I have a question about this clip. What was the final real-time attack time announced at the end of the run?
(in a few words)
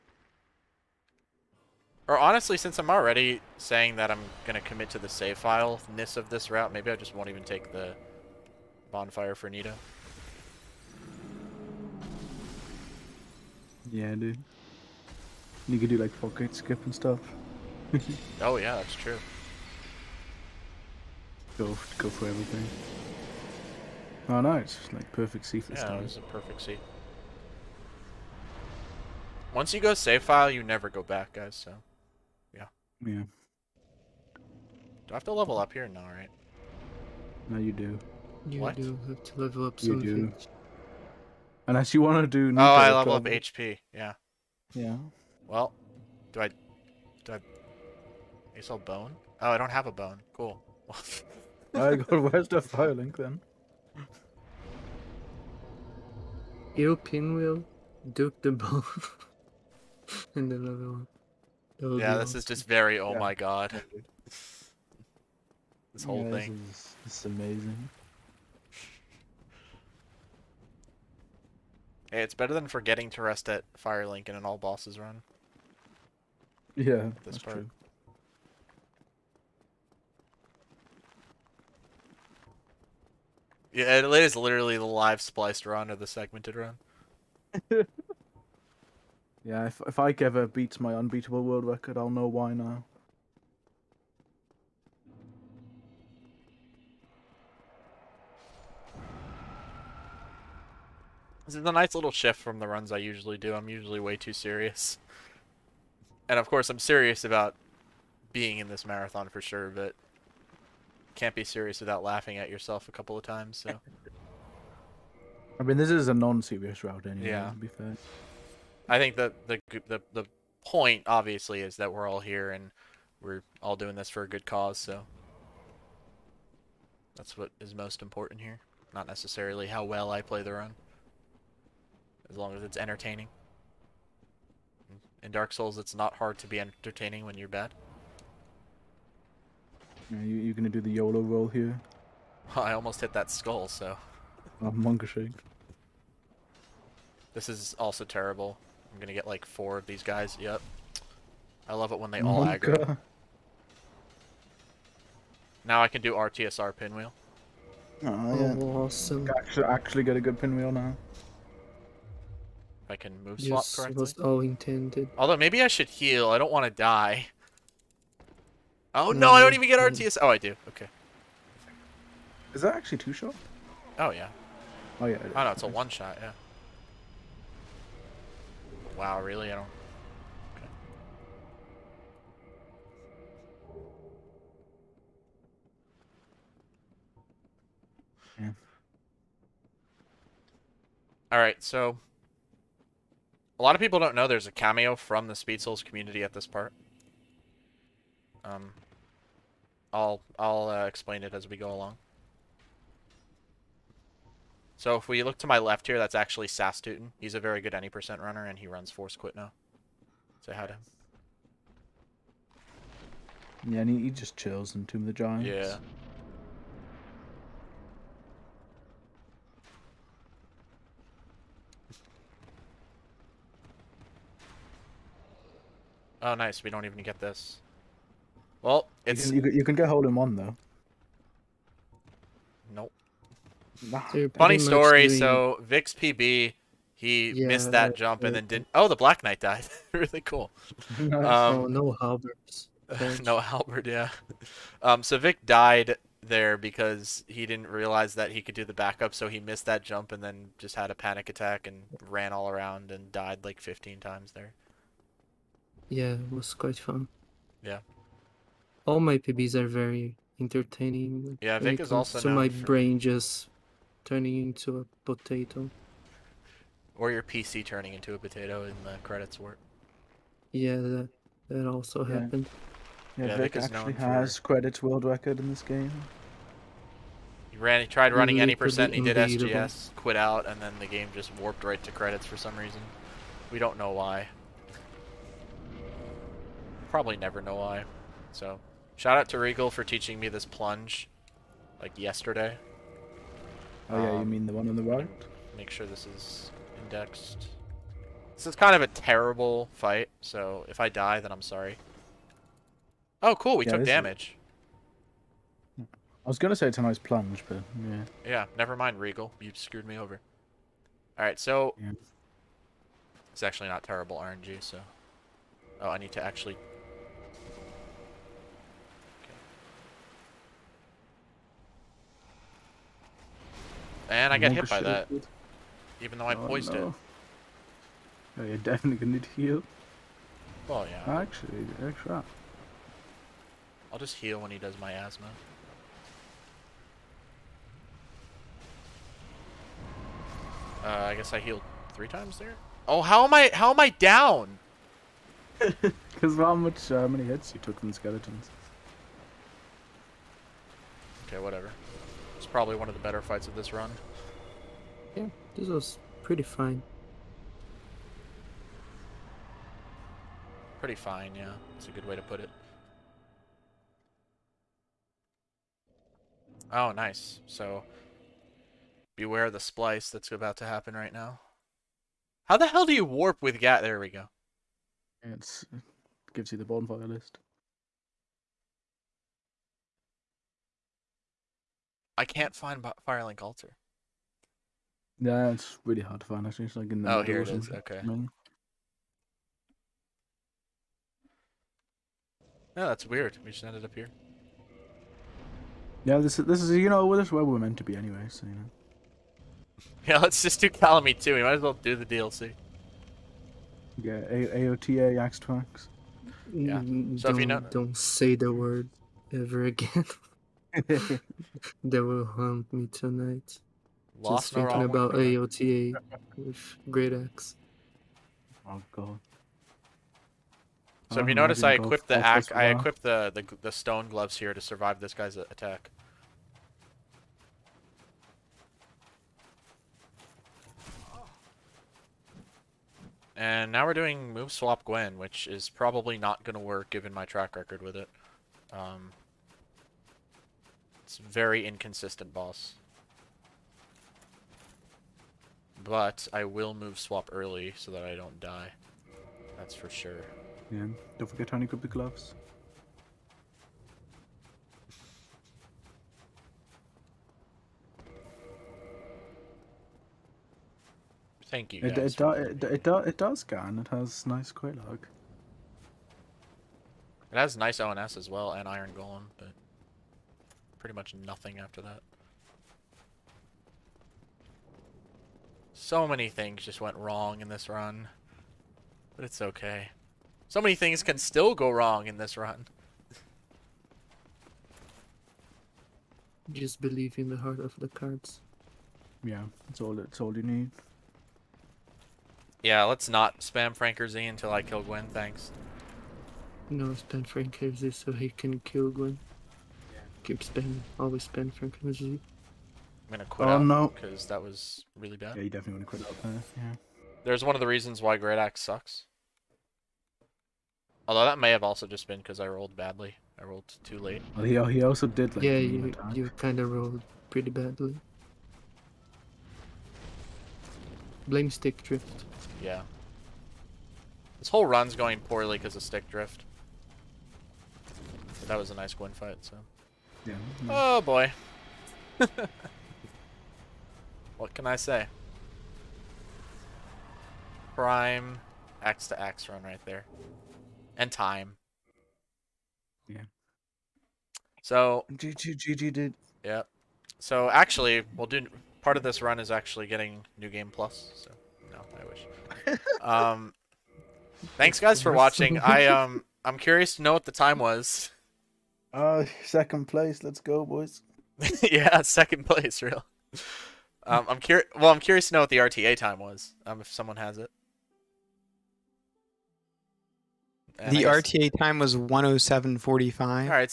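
107.45.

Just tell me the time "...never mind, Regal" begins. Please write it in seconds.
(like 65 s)
308 s.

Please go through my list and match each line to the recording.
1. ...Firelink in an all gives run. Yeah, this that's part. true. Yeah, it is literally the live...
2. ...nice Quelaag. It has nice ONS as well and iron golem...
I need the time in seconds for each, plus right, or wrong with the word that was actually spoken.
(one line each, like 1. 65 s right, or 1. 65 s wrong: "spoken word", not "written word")
1. 73 s wrong: "bosses", not "gives"
2. 464 s right.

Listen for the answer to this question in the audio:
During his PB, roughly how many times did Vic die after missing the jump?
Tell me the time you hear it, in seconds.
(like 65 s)
253 s.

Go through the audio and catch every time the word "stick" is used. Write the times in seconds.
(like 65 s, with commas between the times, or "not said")
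521 s, 525 s.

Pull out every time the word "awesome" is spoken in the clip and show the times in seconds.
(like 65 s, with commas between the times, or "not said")
62 s, 158 s.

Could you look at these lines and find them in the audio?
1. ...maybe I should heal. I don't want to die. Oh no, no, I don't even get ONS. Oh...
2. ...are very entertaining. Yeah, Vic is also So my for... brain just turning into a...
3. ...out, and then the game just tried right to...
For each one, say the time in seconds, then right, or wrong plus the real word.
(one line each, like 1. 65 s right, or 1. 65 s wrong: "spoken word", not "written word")
1. 165 s wrong: "RTS", not "ONS"
2. 259 s right
3. 280 s wrong: "warped", not "tried".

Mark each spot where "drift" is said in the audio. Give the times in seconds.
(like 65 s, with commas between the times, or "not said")
521 s, 526 s.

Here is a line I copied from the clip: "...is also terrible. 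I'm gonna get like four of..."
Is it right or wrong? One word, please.
right.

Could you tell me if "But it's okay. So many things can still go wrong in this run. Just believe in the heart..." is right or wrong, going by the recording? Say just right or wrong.
right.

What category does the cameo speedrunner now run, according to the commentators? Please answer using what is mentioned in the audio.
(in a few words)
Force Quit.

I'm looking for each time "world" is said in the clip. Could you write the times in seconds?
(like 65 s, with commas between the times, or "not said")
91 s, 274 s.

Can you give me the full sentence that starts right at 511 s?
Although that may have also just been because I rolled badly.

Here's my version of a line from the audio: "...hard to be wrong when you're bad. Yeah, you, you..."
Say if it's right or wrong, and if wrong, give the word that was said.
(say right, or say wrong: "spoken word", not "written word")
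wrong: "entertaining", not "wrong".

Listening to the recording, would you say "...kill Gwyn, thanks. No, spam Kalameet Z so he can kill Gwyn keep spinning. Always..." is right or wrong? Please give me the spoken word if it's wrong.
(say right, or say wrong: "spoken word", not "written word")
wrong: "Franker", not "Kalameet".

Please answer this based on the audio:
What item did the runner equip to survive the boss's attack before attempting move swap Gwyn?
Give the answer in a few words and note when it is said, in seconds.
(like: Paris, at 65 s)
stone gloves, at 423 s.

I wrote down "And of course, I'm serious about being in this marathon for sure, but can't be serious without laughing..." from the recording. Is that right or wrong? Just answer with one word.
right.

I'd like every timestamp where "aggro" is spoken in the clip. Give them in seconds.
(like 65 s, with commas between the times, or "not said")
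152 s.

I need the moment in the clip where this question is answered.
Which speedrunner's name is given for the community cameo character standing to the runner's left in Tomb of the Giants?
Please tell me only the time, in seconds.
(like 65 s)
206 s.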